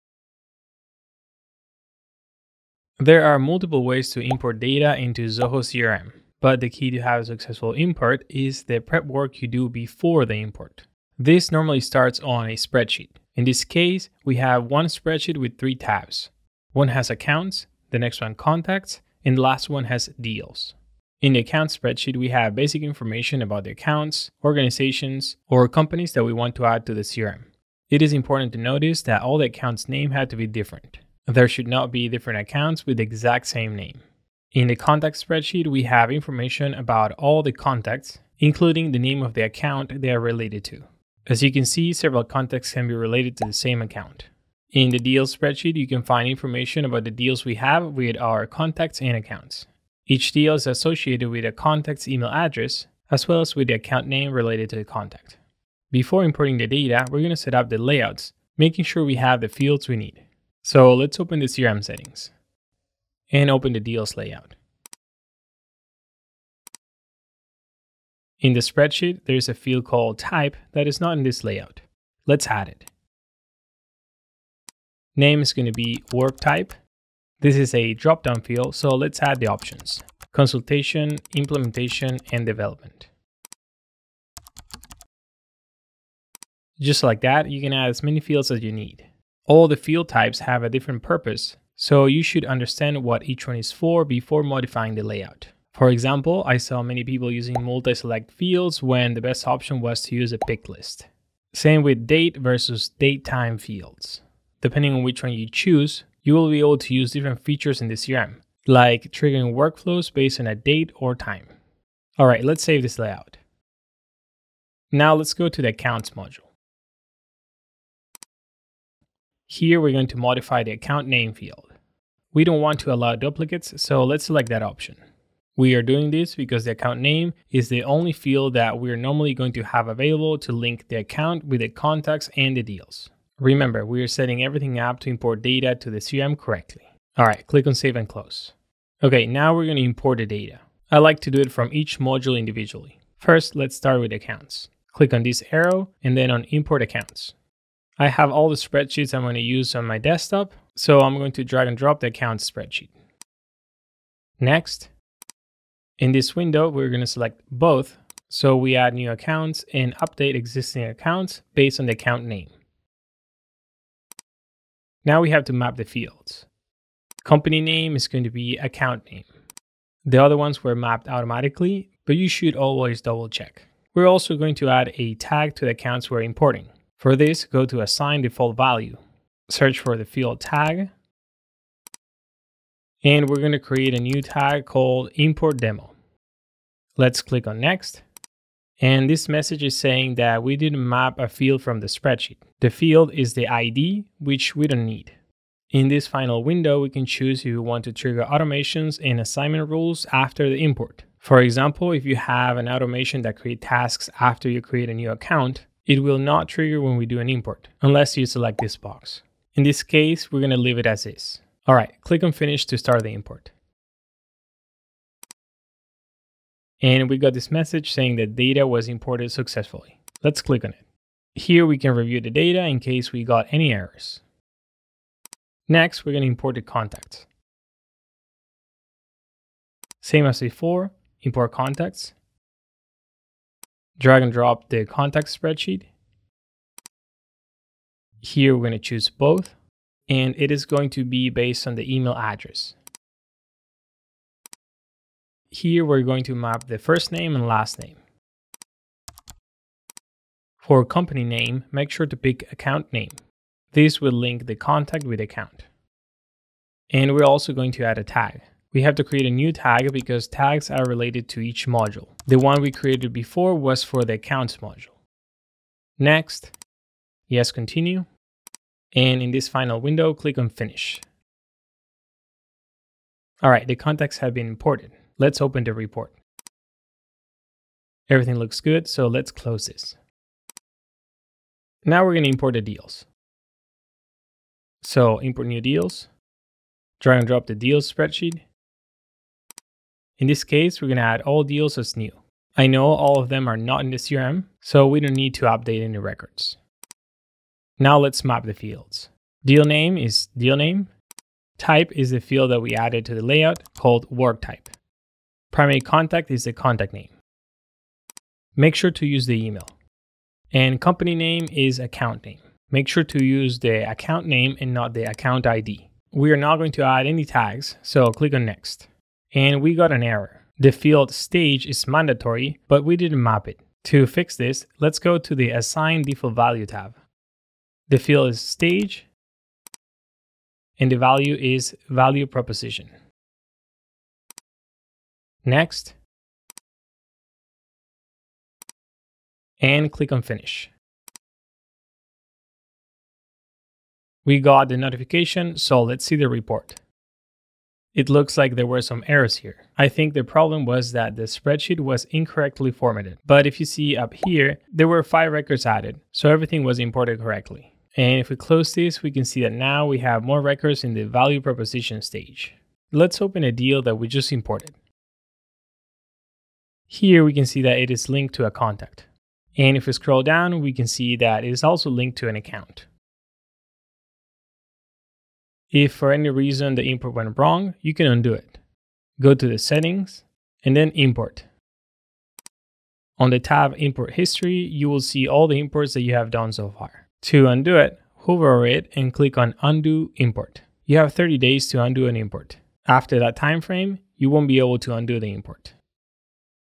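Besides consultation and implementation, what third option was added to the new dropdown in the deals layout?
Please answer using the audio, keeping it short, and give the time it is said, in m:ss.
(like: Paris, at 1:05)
development, at 1:22.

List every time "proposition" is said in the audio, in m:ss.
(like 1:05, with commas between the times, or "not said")
5:32, 6:01.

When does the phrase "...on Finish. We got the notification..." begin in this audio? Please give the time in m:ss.
5:40.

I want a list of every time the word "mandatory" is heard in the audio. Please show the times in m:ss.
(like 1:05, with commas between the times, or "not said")
5:21.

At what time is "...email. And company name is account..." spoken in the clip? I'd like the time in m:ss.
5:09.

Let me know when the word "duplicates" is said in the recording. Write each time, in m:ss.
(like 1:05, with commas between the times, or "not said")
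2:03.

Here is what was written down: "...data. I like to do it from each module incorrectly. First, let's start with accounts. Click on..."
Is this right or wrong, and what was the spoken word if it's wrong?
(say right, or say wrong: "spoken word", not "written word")
wrong: "individually", not "incorrectly".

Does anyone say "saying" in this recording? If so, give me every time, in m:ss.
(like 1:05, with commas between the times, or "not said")
3:09, 3:37.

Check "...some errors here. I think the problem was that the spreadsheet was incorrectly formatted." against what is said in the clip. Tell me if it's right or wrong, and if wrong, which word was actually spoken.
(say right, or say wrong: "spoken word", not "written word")
right.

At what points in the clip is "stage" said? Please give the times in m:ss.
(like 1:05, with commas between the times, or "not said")
5:21, 5:28, 6:02.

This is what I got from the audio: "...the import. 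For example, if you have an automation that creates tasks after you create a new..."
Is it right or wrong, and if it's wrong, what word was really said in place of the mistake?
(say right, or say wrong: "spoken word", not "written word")
right.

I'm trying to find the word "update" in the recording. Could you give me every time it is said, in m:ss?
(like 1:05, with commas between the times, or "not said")
2:39, 4:55.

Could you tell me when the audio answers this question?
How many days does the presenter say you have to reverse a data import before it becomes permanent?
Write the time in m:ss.
6:31.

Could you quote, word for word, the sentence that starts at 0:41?
As you can see, several contacts can be related to the same account.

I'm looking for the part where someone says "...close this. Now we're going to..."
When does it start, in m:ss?
4:39.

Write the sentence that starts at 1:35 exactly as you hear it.
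For example, I saw many people using multi-select fields when the best option was to use a pick list.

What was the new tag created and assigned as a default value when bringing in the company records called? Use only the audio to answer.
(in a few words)
import demo.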